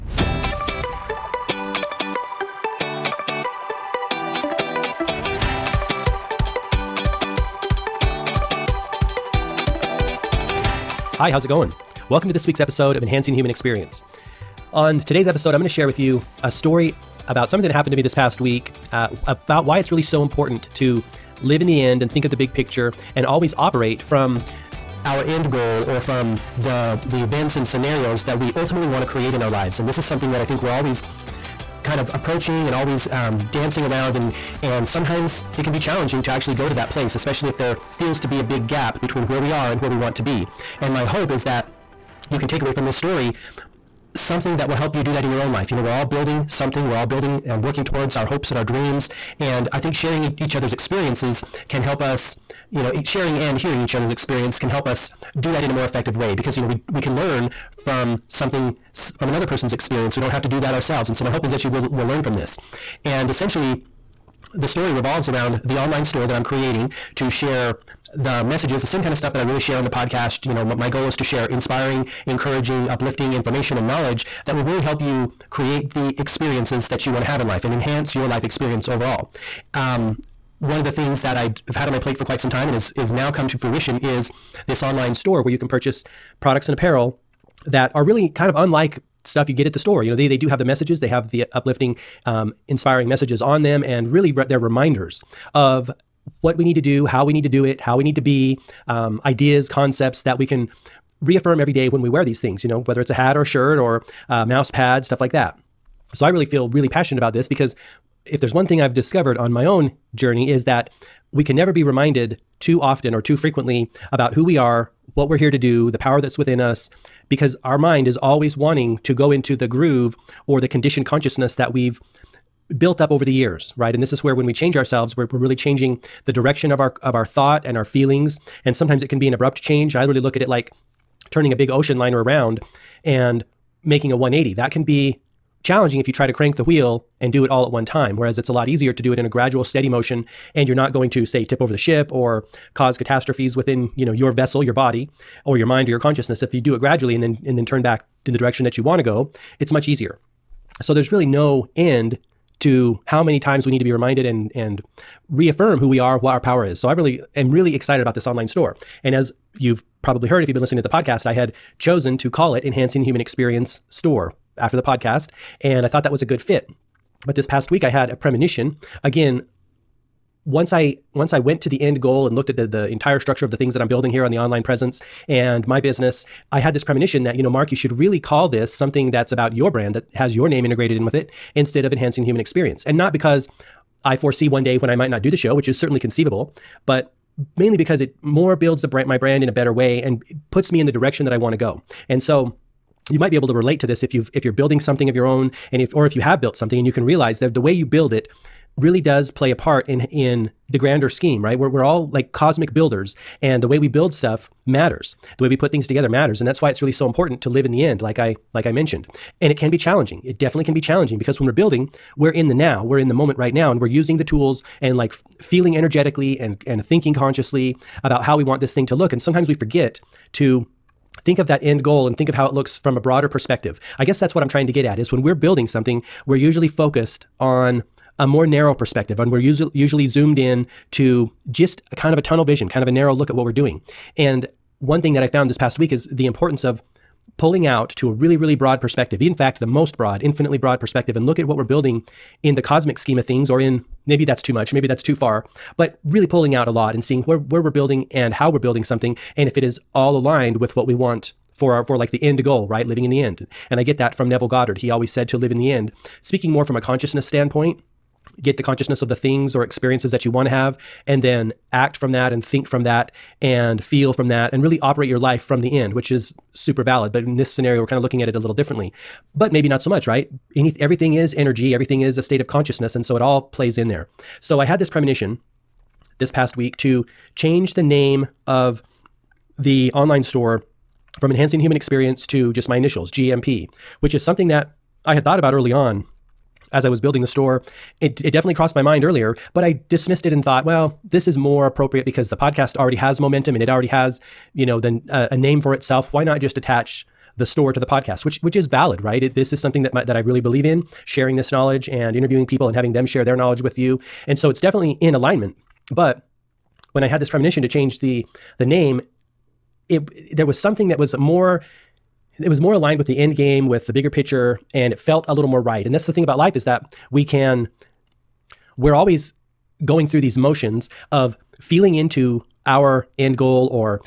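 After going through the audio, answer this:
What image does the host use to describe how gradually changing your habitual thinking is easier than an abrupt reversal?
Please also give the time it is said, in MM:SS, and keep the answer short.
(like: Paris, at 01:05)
Ocean liner, at 02:11.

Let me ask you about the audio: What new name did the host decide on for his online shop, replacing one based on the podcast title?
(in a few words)
GMP.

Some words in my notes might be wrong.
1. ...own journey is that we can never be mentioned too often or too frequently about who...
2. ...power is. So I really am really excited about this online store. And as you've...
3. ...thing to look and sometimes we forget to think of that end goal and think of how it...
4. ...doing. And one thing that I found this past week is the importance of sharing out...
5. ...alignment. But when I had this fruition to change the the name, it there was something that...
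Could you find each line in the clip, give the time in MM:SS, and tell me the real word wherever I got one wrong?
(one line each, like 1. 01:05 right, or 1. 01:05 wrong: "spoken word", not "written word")
1. 01:49 wrong: "reminded", not "mentioned"
2. 02:36 right
3. 03:38 right
4. 03:53 wrong: "pulling", not "sharing"
5. 05:05 wrong: "premonition", not "fruition".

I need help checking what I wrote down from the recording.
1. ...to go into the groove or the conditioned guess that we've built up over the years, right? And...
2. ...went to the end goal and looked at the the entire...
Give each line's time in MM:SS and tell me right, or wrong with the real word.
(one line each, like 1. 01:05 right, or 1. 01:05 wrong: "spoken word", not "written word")
1. 01:59 wrong: "consciousness", not "guess"
2. 02:51 right.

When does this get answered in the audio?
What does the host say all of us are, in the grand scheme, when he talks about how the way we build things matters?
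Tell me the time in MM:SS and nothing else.
03:22.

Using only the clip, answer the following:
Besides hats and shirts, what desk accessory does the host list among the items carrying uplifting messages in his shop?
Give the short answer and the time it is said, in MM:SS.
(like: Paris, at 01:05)
Mouse pad, at 01:44.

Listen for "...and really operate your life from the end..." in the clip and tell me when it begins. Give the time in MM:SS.
04:24.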